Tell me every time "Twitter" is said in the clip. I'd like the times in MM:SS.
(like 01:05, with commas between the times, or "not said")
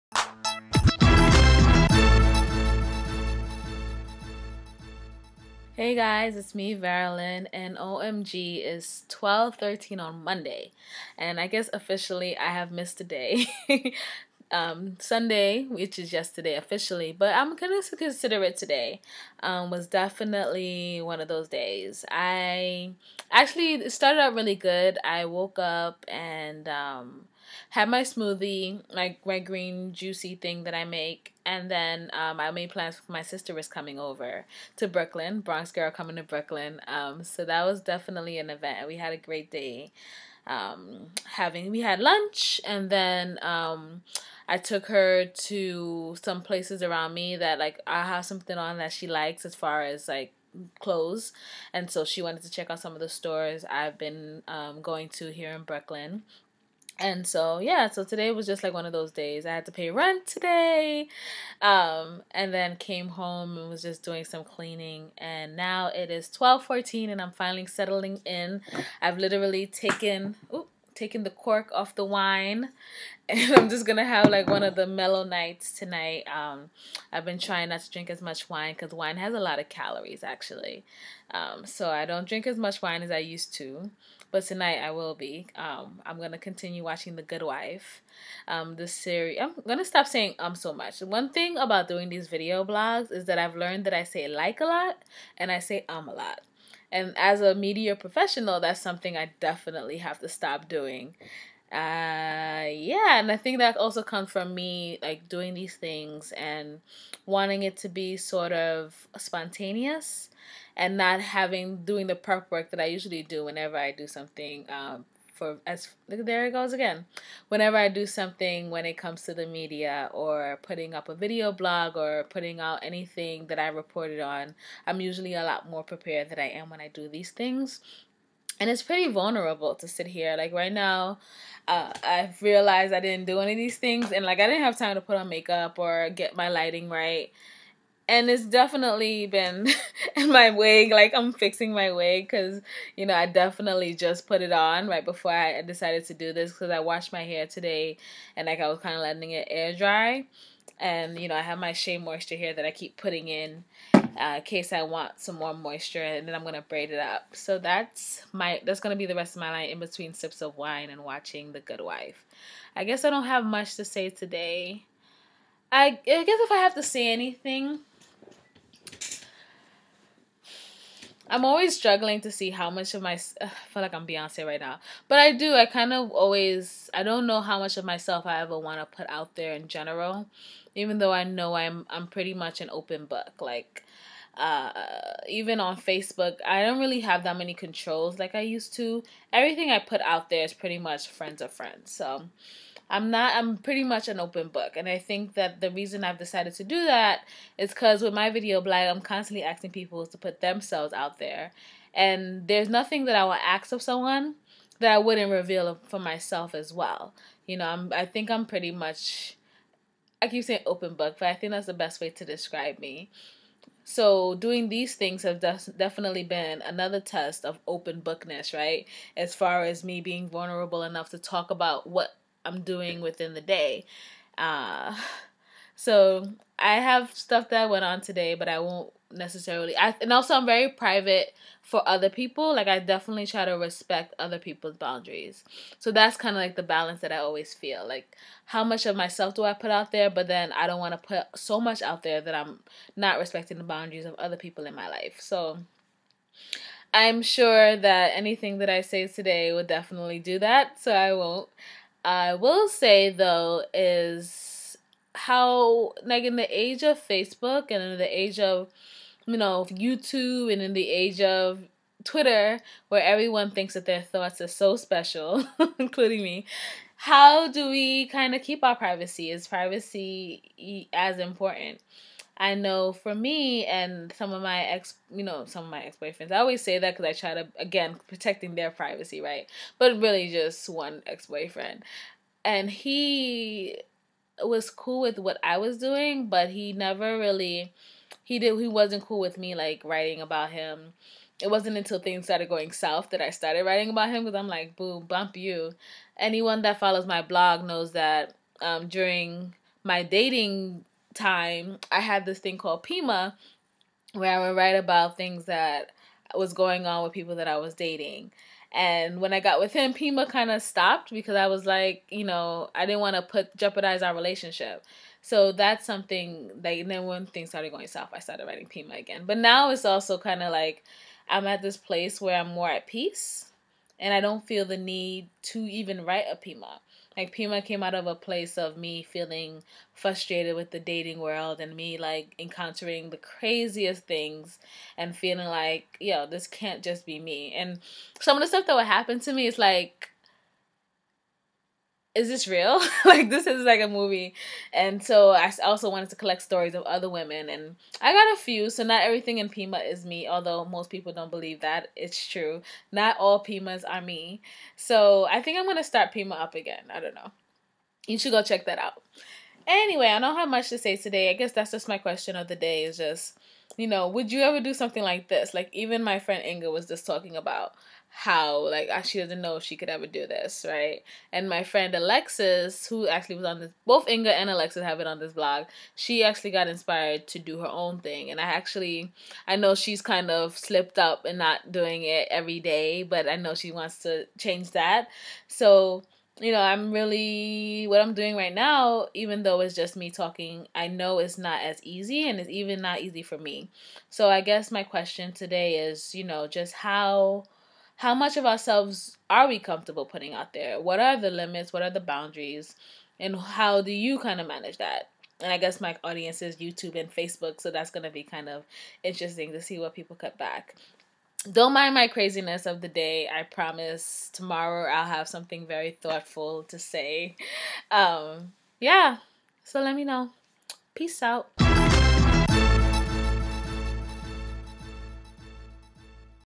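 04:22.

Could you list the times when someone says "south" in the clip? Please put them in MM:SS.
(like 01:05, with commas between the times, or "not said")
04:52, 05:17.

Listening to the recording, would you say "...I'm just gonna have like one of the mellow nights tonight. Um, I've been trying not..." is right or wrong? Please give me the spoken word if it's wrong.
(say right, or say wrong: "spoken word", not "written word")
right.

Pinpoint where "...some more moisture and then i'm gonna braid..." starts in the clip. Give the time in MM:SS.
02:35.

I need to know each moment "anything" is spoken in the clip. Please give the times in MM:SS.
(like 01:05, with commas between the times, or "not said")
02:02, 02:47, 04:08.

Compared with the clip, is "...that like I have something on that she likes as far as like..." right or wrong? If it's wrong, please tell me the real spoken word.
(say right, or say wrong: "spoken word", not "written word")
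right.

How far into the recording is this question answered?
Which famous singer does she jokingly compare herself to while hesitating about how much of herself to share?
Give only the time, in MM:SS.
02:54.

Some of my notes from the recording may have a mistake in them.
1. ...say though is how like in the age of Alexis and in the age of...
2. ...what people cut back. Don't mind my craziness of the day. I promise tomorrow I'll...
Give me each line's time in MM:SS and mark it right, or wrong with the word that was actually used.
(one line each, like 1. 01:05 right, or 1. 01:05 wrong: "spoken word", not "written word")
1. 04:12 wrong: "Facebook", not "Alexis"
2. 06:49 right.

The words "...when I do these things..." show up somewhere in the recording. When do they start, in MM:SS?
02:06.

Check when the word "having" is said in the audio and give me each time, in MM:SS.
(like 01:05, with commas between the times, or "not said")
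00:41, 01:51.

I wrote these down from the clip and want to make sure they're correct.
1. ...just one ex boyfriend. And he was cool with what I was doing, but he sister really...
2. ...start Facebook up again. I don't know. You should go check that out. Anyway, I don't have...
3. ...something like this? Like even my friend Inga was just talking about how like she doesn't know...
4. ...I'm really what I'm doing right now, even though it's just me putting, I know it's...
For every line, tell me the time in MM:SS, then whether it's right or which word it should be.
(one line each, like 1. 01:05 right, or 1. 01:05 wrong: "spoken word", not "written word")
1. 04:40 wrong: "never", not "sister"
2. 05:55 wrong: "Pima", not "Facebook"
3. 06:04 right
4. 06:26 wrong: "talking", not "putting".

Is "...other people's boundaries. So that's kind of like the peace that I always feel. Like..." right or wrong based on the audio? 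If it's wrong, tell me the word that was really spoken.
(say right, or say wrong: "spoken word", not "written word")
wrong: "balance", not "peace".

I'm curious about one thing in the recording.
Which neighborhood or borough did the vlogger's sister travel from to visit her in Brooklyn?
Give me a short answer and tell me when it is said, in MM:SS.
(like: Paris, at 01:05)
Bronx, at 00:35.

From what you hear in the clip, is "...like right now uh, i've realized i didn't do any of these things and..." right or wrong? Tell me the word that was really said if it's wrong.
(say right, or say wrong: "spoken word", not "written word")
right.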